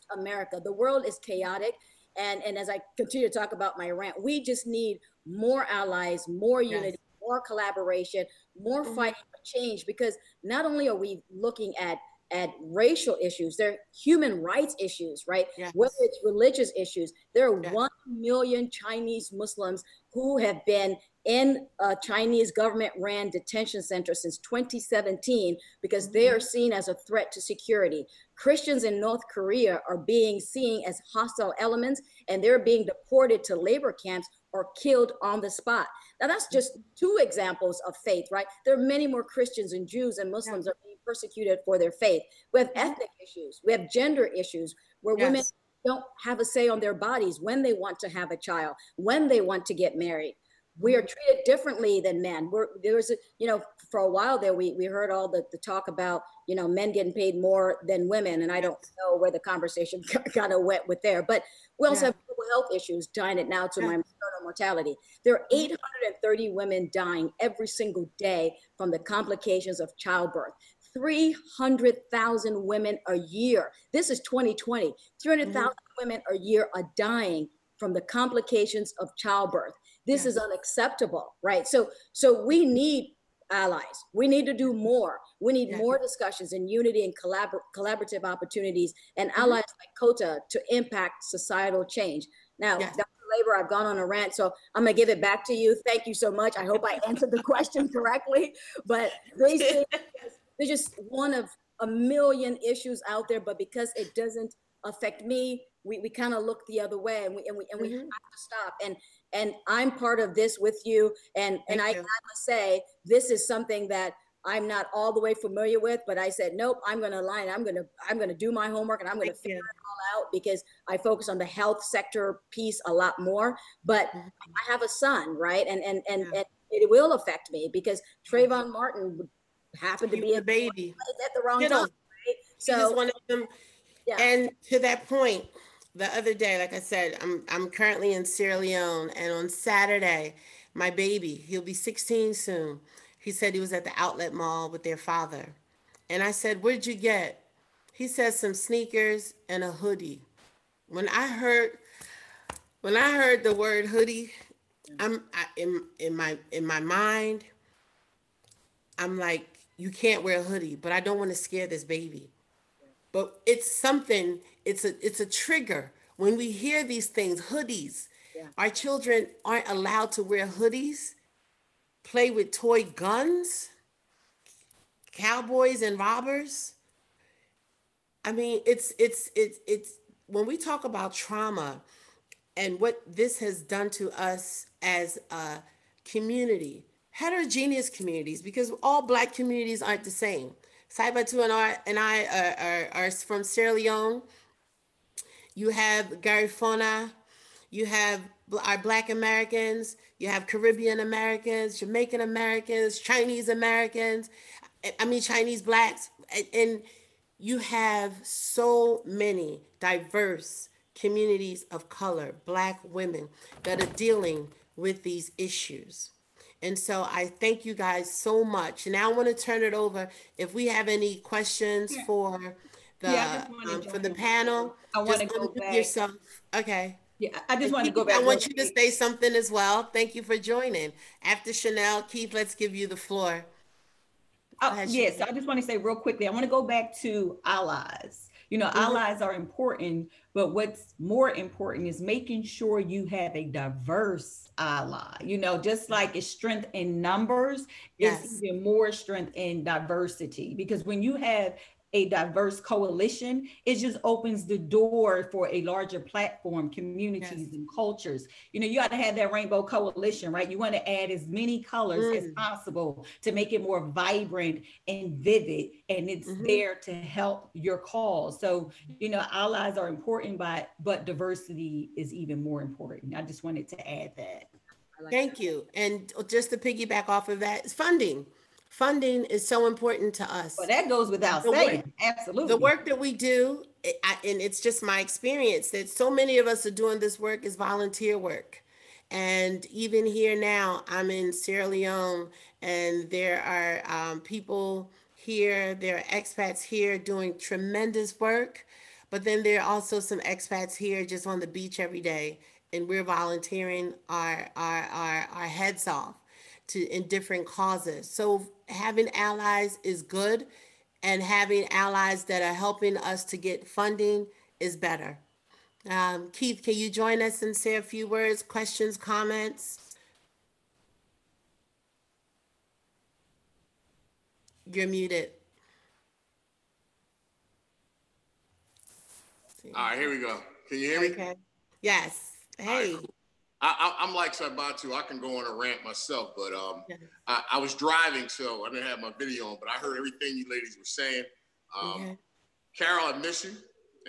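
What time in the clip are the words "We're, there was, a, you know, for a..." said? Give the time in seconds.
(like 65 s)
52 s.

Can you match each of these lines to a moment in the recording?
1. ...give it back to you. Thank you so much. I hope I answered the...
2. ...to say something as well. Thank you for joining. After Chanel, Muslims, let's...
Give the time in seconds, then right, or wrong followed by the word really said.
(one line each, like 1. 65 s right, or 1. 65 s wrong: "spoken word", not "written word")
1. 94 s right
2. 228 s wrong: "Keith", not "Muslims".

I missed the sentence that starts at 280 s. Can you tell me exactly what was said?
Well, that goes without the saying.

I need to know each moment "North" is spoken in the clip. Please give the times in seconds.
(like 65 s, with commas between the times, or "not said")
29 s.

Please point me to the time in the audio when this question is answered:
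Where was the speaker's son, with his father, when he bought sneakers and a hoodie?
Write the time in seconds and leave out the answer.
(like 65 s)
143 s.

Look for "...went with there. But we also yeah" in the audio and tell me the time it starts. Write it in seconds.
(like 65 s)
60 s.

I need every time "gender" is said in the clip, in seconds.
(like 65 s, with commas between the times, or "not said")
43 s.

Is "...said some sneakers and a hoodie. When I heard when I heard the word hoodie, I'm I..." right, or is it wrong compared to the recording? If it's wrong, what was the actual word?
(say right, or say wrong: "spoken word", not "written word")
right.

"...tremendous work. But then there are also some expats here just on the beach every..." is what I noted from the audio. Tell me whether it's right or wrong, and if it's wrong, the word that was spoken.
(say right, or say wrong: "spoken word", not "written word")
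right.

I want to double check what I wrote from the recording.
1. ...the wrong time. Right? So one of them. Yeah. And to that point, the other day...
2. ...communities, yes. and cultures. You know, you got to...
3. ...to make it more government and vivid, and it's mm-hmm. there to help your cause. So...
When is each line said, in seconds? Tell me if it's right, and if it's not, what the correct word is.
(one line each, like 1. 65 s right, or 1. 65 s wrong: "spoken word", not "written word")
1. 131 s right
2. 256 s right
3. 263 s wrong: "vibrant", not "government".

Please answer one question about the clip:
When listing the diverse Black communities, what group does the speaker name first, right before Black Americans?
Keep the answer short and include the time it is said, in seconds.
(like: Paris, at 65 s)
Garifuna, at 196 s.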